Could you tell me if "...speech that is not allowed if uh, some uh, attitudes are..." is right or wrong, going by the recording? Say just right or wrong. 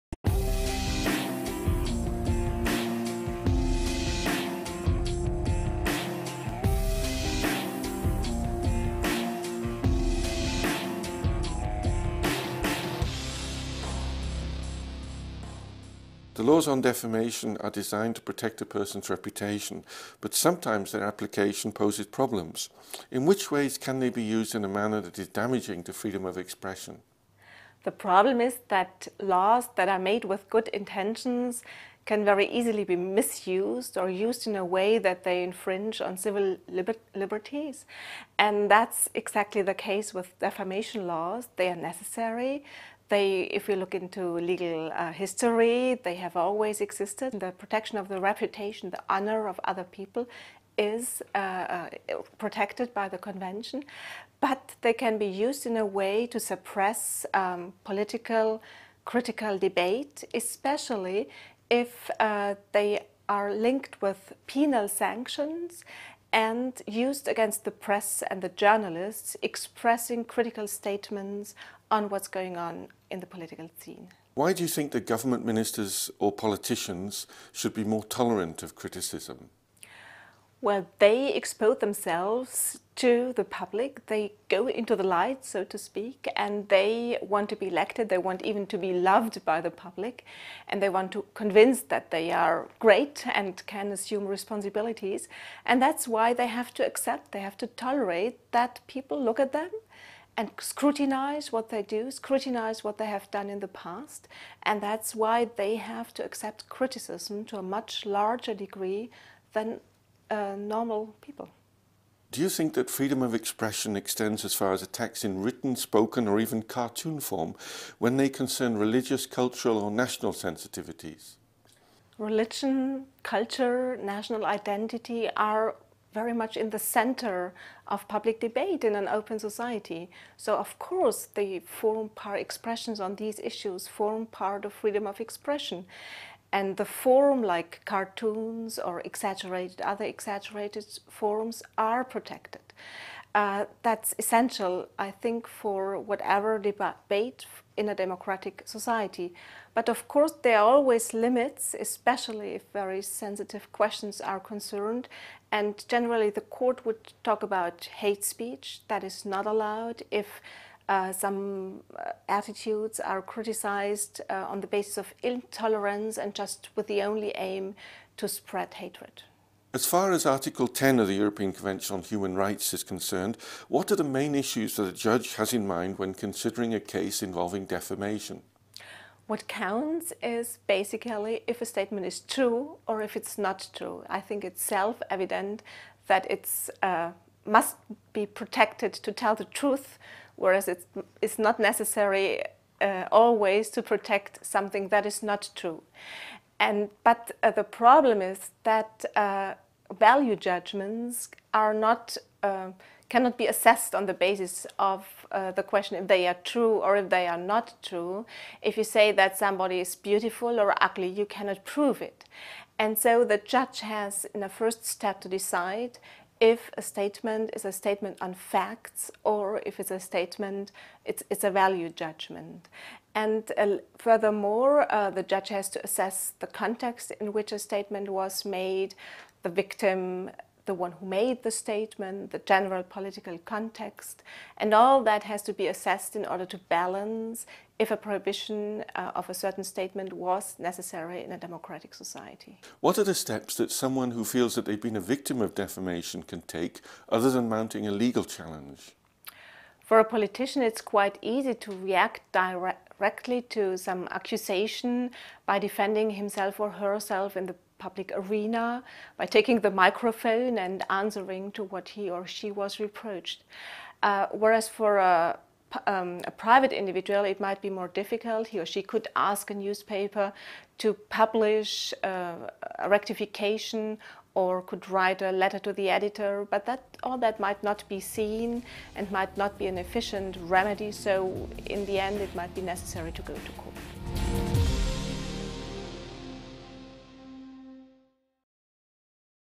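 right.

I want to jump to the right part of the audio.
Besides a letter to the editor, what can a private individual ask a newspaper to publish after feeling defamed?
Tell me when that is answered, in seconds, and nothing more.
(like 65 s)
272 s.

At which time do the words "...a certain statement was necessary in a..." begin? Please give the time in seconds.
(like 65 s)
239 s.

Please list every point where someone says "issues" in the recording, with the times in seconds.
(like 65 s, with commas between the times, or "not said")
133 s, 174 s.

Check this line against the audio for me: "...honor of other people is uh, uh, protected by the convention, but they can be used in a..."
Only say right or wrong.
right.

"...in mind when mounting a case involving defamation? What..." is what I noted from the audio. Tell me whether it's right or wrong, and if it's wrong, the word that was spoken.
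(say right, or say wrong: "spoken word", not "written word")
wrong: "considering", not "mounting".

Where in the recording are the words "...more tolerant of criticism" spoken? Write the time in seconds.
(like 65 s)
77 s.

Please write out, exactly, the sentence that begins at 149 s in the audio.
But of course, there are always limits, especially if very sensitive questions are concerned.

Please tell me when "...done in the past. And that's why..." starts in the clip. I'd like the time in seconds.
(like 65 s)
103 s.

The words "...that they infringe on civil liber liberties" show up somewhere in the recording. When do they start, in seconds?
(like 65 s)
34 s.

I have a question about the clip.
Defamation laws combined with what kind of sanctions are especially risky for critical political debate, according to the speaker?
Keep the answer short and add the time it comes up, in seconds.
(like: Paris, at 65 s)
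penal sanctions, at 64 s.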